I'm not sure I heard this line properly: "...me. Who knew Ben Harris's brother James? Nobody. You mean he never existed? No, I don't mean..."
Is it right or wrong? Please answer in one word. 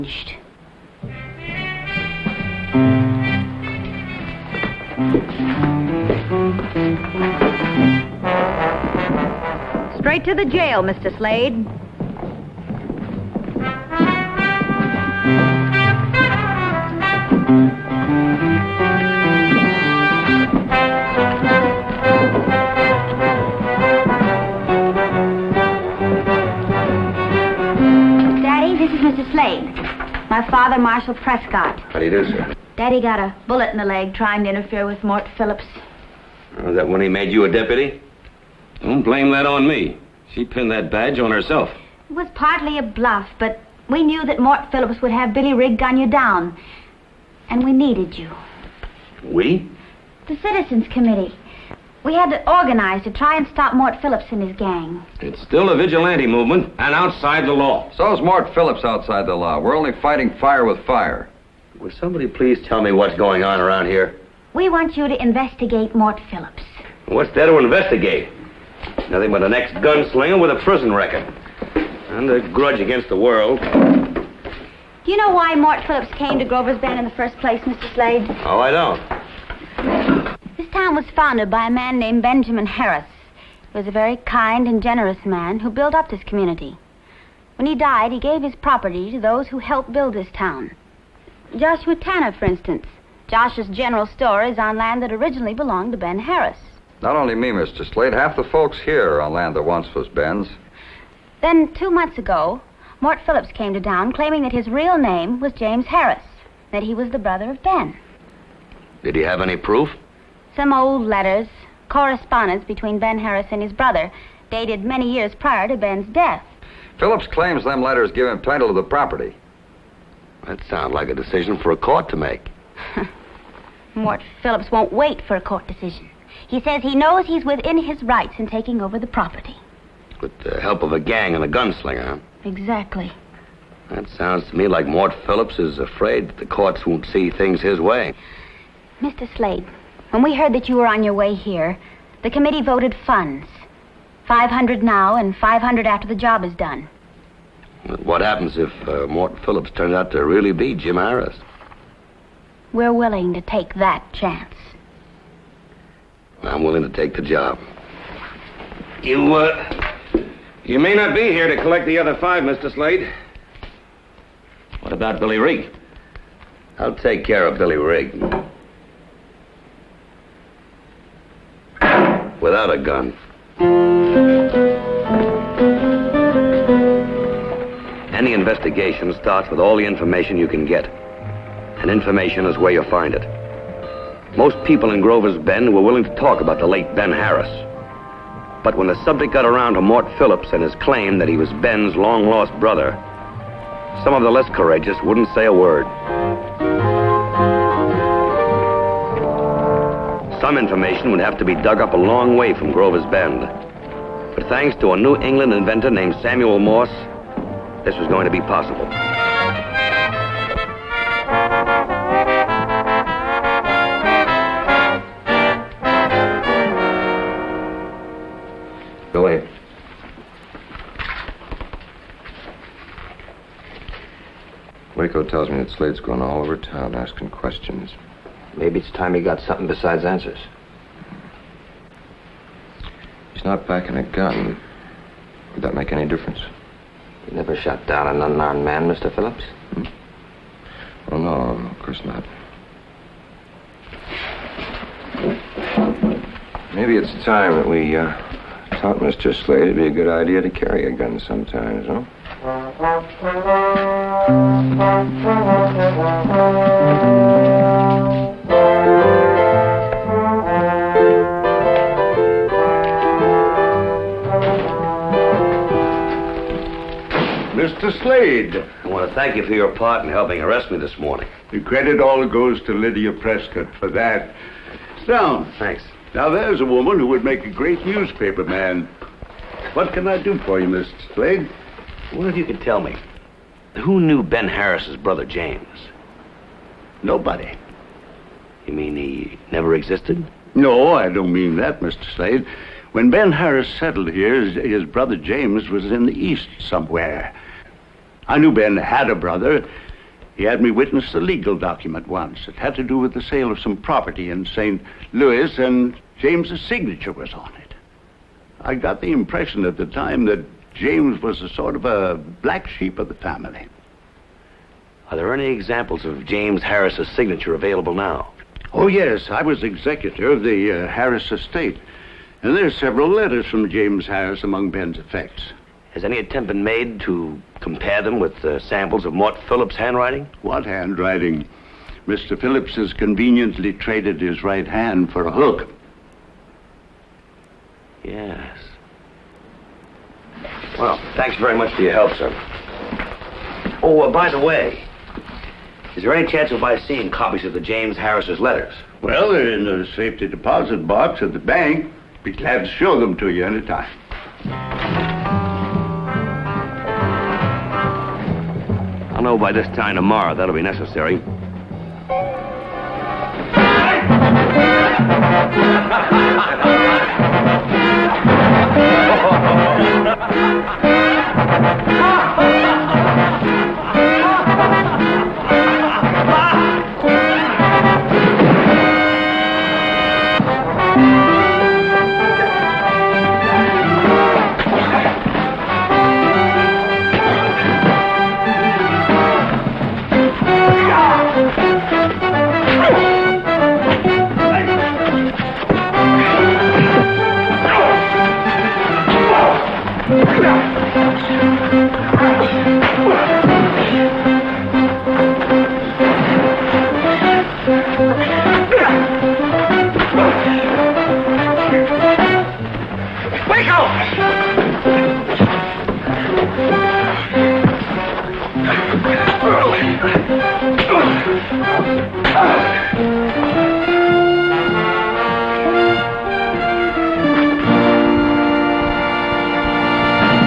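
right.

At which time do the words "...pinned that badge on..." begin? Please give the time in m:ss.
0:40.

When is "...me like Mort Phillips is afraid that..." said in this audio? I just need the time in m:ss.
2:14.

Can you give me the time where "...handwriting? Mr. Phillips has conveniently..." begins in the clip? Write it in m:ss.
5:30.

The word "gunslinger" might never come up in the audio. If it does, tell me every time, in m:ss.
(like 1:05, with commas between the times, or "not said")
1:09, 2:11.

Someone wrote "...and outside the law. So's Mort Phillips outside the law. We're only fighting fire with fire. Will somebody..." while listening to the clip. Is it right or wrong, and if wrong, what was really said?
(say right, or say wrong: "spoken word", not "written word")
right.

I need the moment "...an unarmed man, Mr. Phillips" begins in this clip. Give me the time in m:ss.
3:58.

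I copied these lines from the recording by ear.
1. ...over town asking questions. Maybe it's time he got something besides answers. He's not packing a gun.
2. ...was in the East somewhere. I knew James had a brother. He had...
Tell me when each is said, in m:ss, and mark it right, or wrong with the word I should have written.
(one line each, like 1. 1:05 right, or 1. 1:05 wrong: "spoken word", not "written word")
1. 3:46 right
2. 4:55 wrong: "Ben", not "James".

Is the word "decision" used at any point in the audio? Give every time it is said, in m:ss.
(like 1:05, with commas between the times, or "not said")
2:01, 2:05.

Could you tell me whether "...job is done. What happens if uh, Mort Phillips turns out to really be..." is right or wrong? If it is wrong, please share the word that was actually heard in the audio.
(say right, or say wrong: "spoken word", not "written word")
right.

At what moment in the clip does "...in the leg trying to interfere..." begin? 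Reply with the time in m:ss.
0:33.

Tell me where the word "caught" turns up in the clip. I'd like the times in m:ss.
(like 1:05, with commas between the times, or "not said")
not said.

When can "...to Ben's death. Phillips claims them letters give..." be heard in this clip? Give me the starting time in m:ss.
1:55.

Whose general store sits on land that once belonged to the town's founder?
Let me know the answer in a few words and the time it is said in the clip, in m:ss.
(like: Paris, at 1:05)
Joshua Tanner, at 1:31.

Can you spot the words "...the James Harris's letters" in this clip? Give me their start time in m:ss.
5:47.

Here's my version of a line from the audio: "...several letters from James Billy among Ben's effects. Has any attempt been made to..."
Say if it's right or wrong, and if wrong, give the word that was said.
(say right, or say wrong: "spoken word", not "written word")
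wrong: "Harris", not "Billy".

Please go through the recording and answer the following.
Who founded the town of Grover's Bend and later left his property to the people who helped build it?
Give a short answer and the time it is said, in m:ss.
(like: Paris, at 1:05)
Benjamin Harris, at 1:22.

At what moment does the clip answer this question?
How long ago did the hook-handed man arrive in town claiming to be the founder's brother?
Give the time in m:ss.
1:41.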